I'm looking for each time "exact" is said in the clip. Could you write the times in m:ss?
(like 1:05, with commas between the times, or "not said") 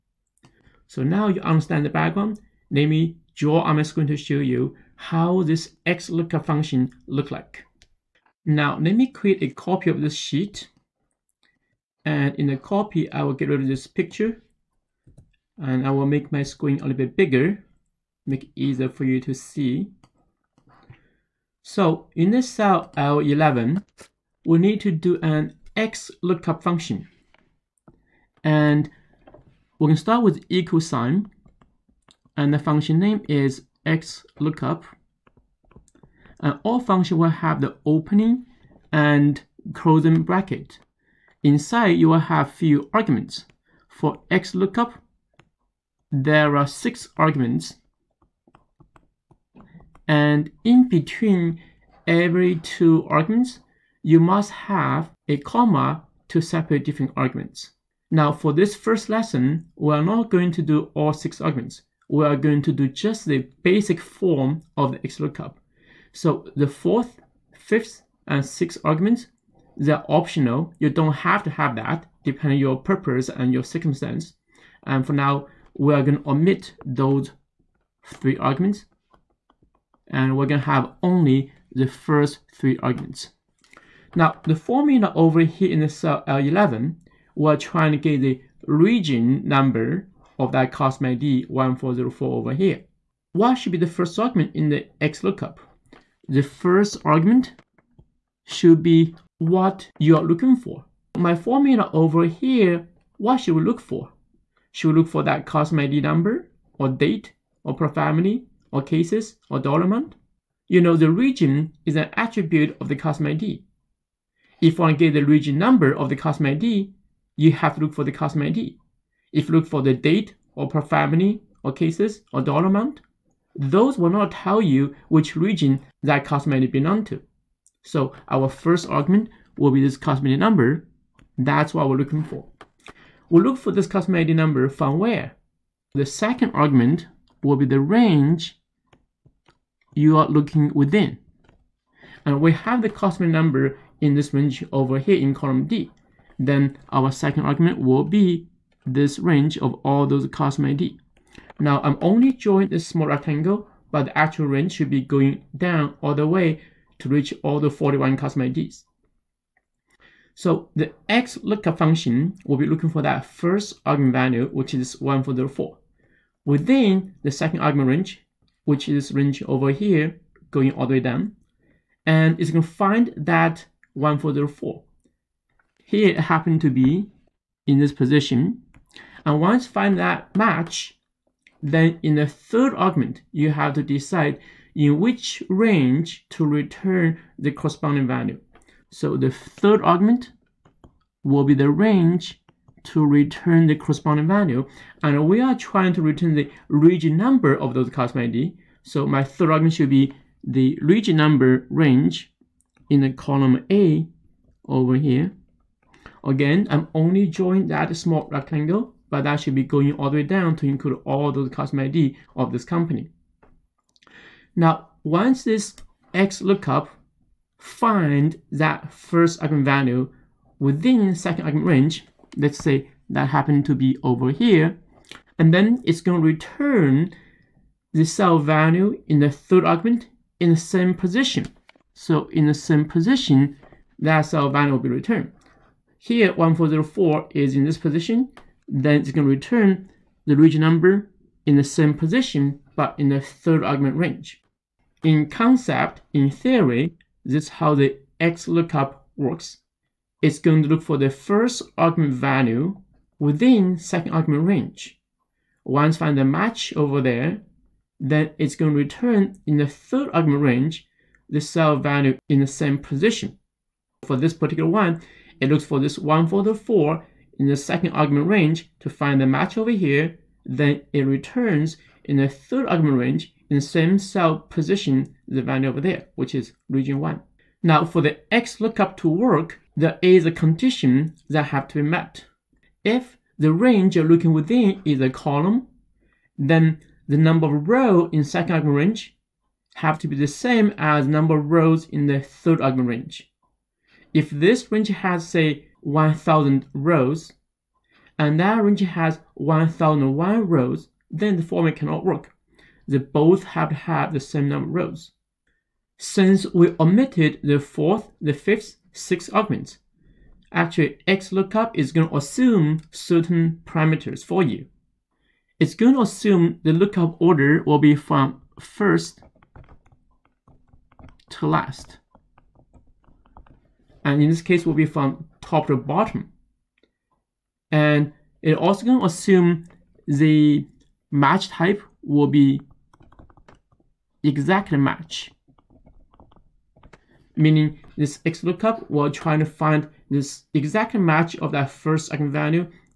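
5:34, 5:40.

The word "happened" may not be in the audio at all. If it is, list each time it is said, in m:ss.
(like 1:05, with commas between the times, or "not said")
2:56, 3:43.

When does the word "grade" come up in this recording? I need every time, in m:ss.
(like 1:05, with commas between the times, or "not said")
not said.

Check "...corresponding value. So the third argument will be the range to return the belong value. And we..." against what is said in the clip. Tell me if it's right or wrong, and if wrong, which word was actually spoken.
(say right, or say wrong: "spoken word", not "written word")
wrong: "corresponding", not "belong".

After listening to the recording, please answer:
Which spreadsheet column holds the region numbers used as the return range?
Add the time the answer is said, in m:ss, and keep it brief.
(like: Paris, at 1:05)
Column A, at 3:23.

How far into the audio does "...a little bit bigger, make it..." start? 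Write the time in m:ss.
0:16.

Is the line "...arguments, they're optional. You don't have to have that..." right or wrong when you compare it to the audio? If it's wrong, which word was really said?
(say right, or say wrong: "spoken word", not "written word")
right.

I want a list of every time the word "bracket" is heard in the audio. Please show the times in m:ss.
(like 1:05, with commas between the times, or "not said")
0:40.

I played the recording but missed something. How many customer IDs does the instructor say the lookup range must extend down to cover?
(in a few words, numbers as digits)
41.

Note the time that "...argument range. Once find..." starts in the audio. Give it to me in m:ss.
4:14.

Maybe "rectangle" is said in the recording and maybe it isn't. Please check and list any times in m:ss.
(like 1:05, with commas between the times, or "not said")
2:33, 3:28.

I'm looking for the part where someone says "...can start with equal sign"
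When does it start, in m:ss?
0:29.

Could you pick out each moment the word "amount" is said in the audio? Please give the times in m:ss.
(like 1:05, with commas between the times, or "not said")
1:49, 2:02.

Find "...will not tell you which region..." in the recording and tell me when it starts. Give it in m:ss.
2:03.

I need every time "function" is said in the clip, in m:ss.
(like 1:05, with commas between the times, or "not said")
0:06, 0:26, 0:32, 0:36, 2:41.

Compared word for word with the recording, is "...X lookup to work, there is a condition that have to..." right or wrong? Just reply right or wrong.
right.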